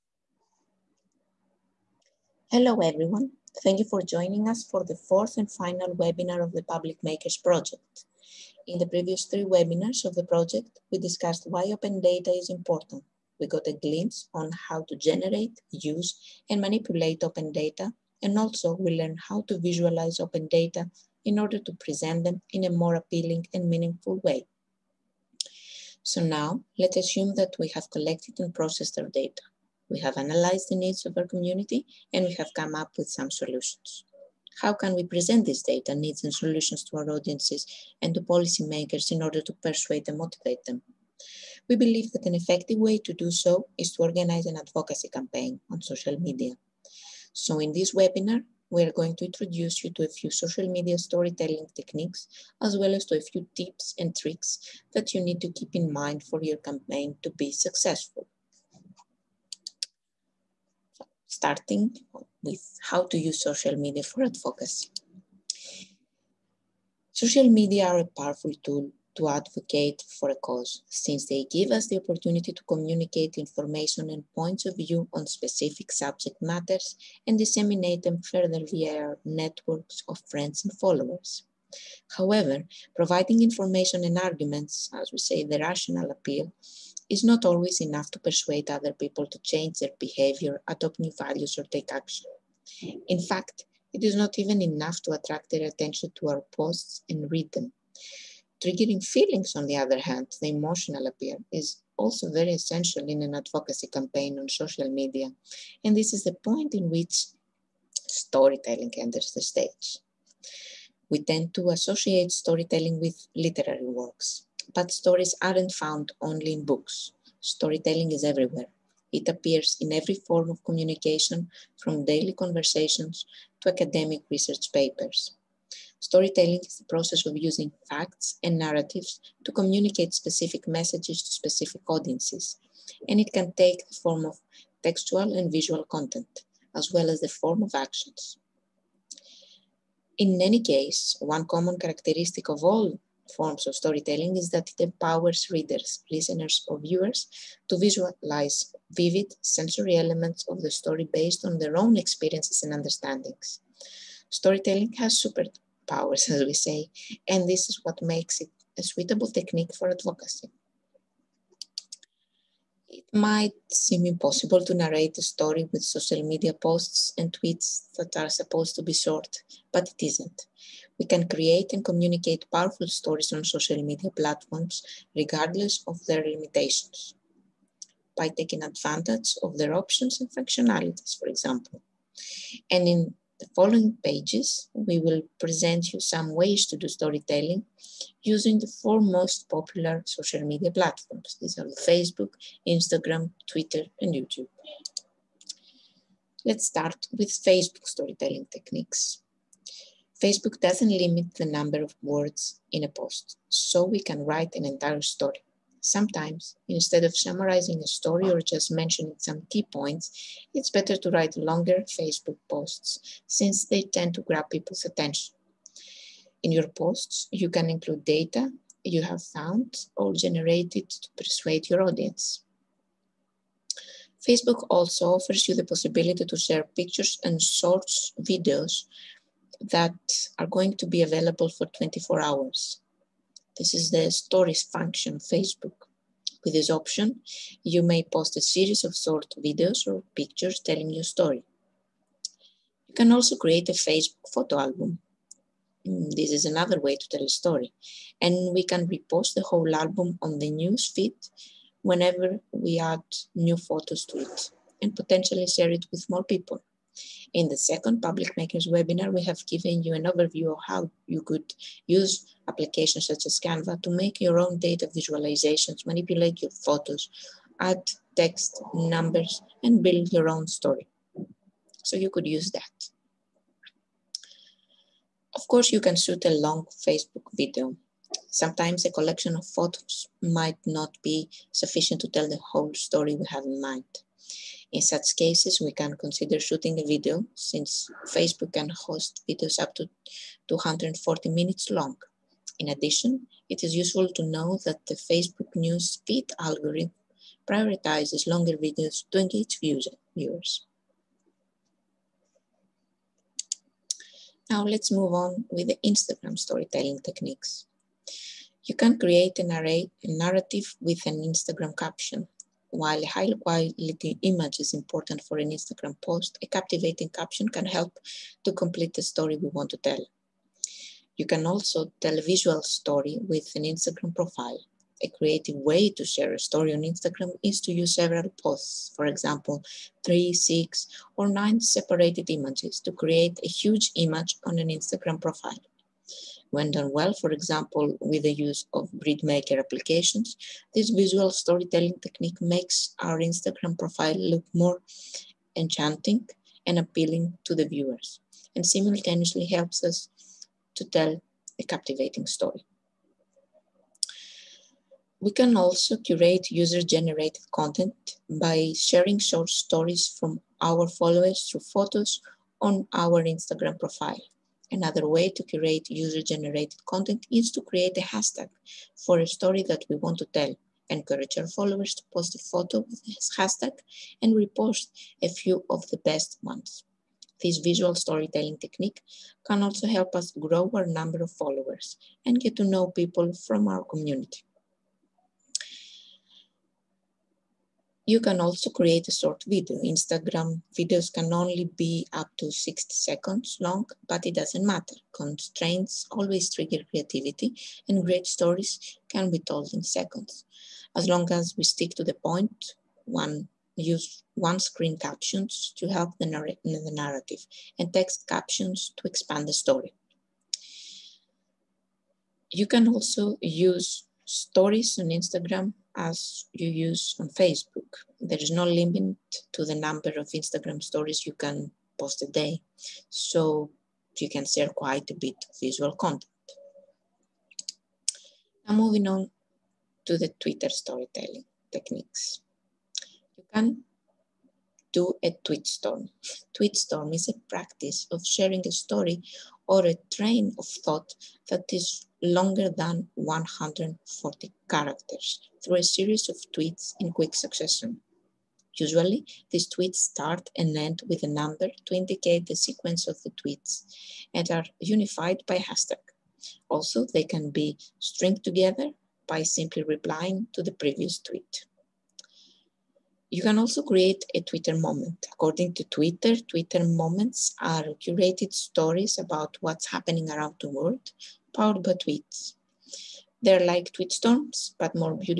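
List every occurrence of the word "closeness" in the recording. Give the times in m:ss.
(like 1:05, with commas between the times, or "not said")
not said.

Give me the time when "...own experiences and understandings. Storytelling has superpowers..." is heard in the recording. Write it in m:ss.
2:31.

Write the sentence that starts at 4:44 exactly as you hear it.
In such cases, we can consider shooting a video since Facebook can host videos up to 240 minutes long.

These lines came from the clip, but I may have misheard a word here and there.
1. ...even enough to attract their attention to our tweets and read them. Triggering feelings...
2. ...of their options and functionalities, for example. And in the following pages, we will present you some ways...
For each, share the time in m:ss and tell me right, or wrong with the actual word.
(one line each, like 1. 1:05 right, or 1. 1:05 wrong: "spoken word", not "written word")
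1. 1:34 wrong: "posts", not "tweets"
2. 2:59 right.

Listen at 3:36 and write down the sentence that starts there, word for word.
In your posts, you can include data you have found or generated to persuade your audience.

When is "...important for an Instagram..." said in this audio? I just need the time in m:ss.
5:14.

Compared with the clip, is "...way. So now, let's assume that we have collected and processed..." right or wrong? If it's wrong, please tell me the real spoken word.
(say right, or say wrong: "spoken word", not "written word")
right.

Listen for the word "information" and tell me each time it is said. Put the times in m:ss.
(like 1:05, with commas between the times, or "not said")
1:13, 1:23.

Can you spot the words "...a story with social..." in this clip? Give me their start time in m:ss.
2:45.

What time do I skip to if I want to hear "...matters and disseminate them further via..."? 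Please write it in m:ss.
1:16.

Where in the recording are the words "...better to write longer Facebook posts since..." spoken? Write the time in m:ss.
3:30.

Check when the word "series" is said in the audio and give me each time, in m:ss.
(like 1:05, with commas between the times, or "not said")
3:58, 7:25.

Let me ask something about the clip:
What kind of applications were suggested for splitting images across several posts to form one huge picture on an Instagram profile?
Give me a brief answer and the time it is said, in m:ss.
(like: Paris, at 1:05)
grid maker applications, at 5:38.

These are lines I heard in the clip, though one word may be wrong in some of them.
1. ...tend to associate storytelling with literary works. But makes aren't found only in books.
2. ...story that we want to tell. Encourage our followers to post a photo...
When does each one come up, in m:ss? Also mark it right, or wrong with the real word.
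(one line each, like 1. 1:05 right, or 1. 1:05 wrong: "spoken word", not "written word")
1. 1:51 wrong: "stories", not "makes"
2. 6:09 right.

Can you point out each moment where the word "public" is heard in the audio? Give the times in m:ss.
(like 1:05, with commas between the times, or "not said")
0:06, 4:17.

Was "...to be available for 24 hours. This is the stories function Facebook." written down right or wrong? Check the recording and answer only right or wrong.
right.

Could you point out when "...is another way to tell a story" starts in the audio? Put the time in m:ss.
4:06.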